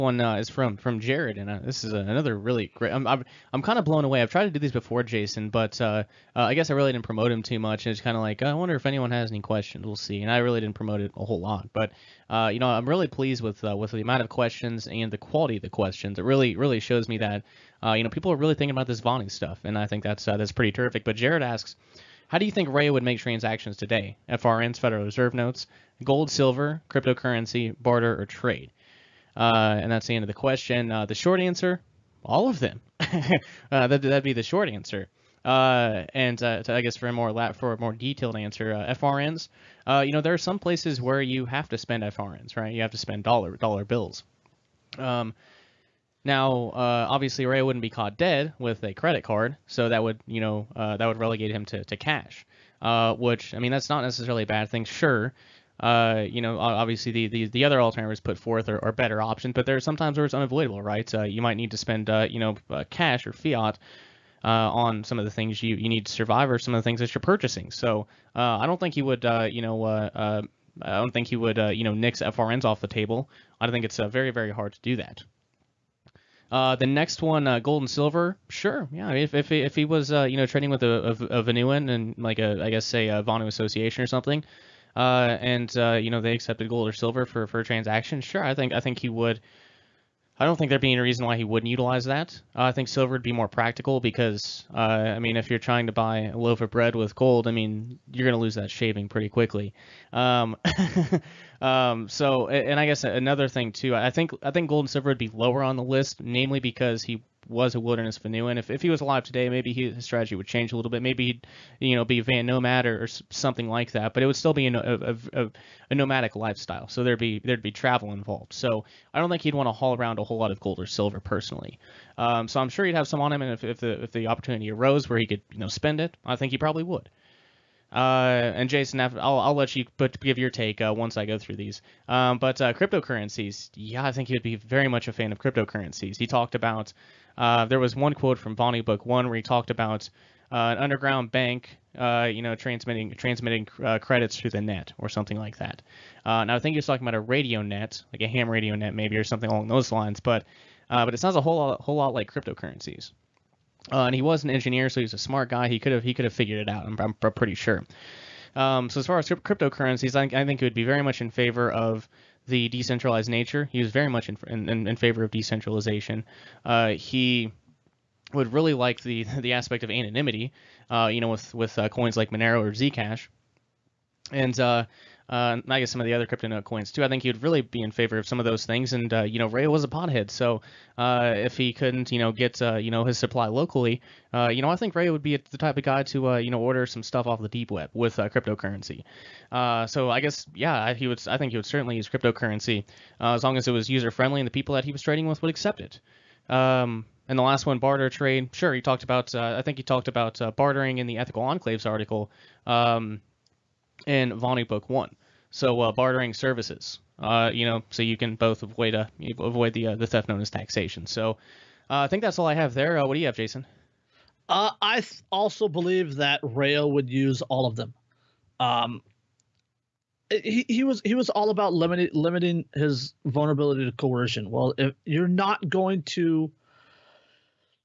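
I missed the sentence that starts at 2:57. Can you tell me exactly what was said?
I think he'd really be in favor of some of those things.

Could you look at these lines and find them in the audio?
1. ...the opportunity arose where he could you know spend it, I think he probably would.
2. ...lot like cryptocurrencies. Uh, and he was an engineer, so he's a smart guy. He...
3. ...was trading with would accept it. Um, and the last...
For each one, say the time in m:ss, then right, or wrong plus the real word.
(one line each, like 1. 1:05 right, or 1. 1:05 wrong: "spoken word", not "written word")
1. 2:04 right
2. 2:31 right
3. 3:14 right.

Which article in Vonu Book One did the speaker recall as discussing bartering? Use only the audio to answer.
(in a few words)
Ethical enclaves.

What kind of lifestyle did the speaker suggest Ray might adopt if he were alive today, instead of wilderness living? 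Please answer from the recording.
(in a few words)
Van Nomad.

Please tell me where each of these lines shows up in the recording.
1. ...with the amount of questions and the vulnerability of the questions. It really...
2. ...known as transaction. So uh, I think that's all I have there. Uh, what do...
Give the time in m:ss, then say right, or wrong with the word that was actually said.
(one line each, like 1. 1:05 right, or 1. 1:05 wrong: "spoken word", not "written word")
1. 0:13 wrong: "quality", not "vulnerability"
2. 3:30 wrong: "taxation", not "transaction".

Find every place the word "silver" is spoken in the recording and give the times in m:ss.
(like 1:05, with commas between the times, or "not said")
0:26, 1:17, 1:26, 1:32, 1:44, 2:00.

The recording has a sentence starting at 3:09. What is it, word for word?
so I guess yeah, he would.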